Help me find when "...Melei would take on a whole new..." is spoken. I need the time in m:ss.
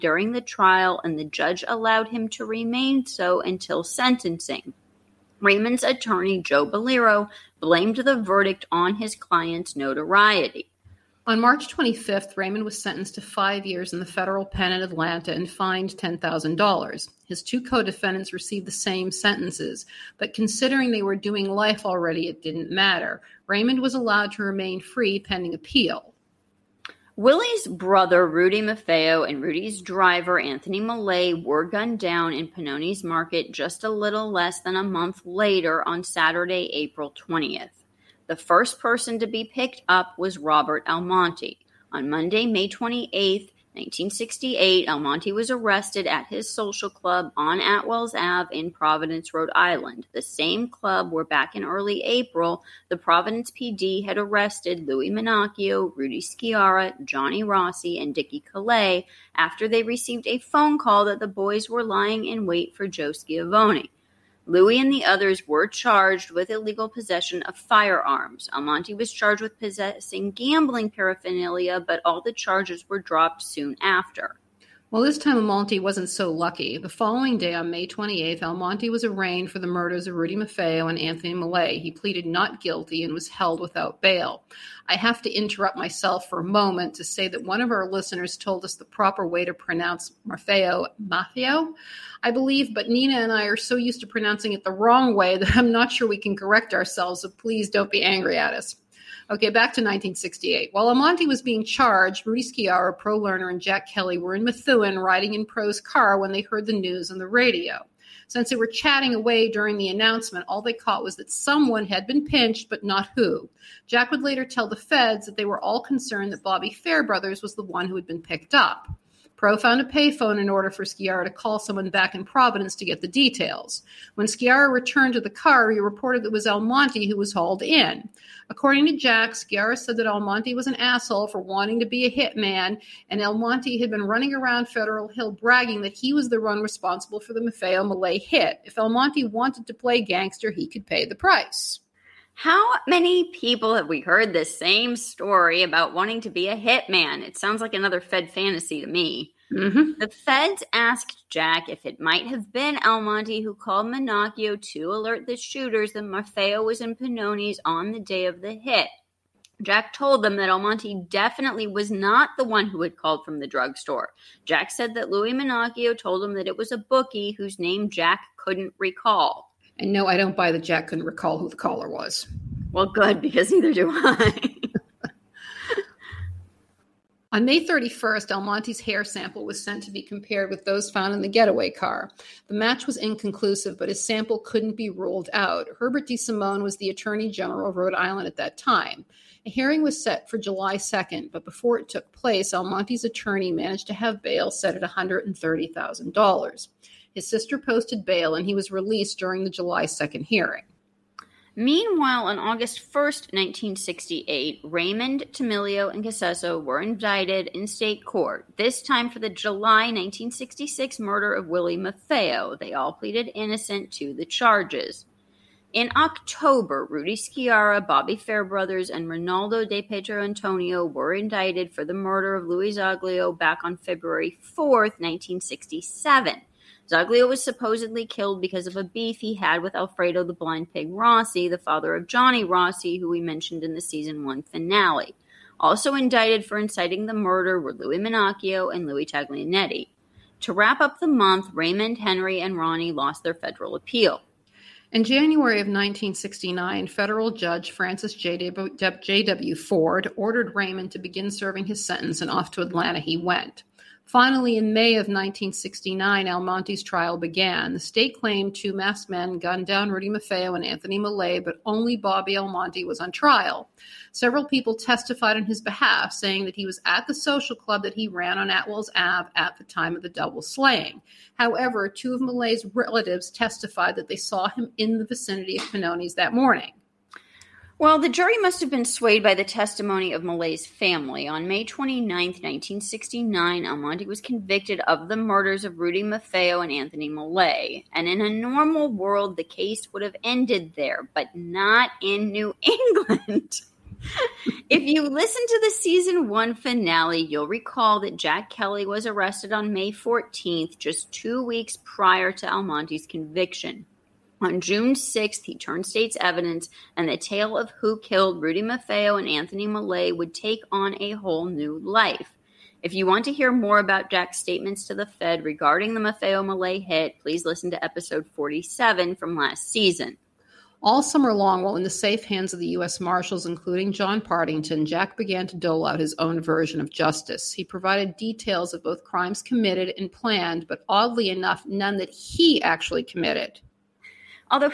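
5:09.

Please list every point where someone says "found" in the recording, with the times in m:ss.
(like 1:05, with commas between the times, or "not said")
1:59, 3:00.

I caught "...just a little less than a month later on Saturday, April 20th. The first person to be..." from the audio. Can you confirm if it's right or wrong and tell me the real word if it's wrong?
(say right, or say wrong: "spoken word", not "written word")
right.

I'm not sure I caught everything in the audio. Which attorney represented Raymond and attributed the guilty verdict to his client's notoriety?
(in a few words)
Joe Balliro.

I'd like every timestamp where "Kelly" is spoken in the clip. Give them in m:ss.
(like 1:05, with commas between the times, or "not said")
1:43, 4:58.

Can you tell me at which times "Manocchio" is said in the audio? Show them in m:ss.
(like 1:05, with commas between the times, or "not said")
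0:55, 2:33, 2:45, 3:57.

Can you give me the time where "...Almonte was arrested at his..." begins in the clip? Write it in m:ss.
0:44.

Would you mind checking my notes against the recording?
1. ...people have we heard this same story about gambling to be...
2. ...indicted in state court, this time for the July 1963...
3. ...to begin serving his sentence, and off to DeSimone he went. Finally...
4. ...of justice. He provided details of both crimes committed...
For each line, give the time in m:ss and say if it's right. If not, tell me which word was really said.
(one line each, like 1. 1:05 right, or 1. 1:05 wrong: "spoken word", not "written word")
1. 2:23 wrong: "wanting", not "gambling"
2. 3:26 wrong: "1966", not "1963"
3. 4:10 wrong: "Atlanta", not "DeSimone"
4. 5:26 right.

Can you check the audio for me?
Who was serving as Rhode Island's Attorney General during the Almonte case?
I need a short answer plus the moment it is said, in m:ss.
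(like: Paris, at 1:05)
Herbert DeSimone, at 3:05.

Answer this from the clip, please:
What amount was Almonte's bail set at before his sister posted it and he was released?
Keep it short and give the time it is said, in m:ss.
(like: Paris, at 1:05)
$130,000, at 3:14.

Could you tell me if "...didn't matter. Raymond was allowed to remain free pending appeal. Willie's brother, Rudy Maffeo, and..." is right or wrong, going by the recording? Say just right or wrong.
right.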